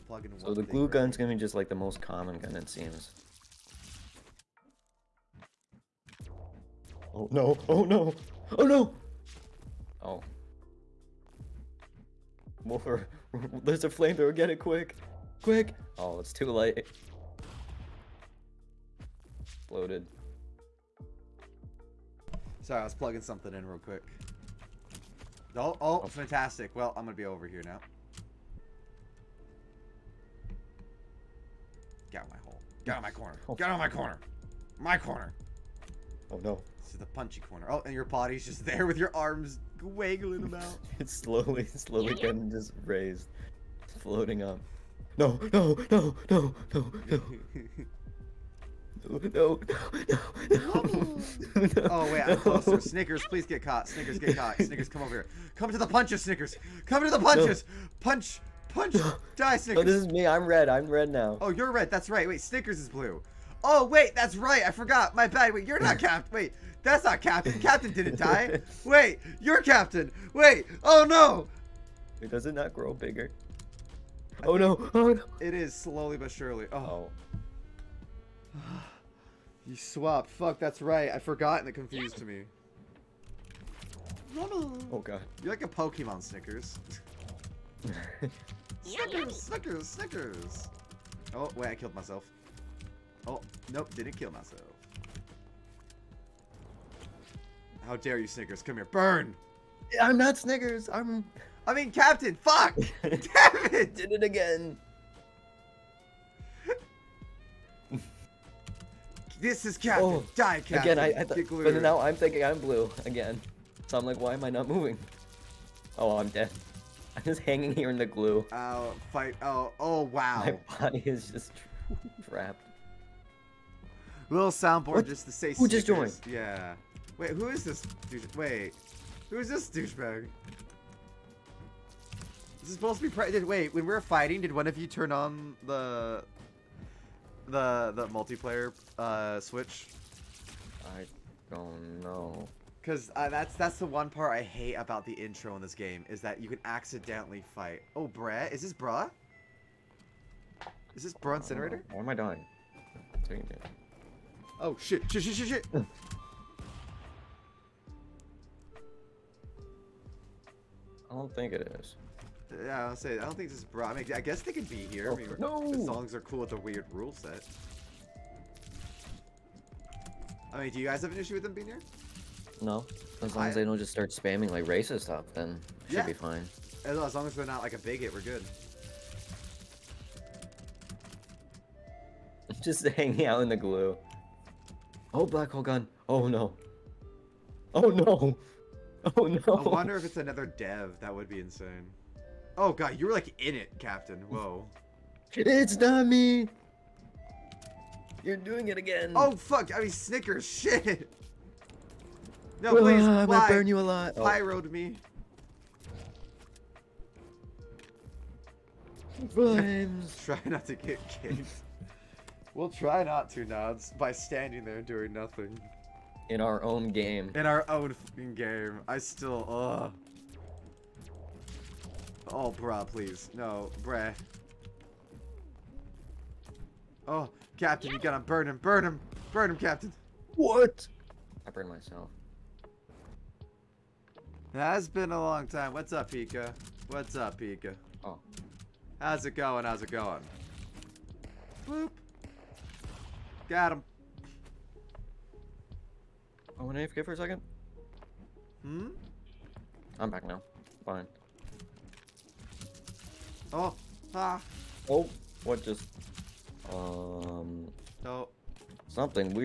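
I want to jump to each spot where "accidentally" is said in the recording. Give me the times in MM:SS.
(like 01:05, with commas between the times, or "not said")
02:26.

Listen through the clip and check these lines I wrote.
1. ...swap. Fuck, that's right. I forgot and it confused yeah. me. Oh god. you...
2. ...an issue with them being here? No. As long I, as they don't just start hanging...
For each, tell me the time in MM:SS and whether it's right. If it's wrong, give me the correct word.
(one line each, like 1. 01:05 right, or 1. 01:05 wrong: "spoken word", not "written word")
1. 01:19 right
2. 02:51 wrong: "spamming", not "hanging".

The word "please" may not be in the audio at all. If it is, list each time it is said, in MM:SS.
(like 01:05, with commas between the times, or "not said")
00:53, 03:22, 03:42.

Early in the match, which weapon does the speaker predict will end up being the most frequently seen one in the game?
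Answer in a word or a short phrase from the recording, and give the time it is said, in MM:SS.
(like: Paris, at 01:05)
Glue gun, at 00:00.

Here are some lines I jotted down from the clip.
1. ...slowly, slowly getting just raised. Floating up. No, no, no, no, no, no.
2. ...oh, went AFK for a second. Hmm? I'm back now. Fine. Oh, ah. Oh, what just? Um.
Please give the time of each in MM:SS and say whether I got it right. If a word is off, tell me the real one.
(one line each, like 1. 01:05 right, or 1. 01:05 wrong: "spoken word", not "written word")
1. 00:41 right
2. 04:06 right.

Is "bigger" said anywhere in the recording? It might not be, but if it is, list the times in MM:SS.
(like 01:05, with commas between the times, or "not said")
01:12.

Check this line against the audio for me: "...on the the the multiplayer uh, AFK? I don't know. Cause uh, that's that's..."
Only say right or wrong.
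wrong.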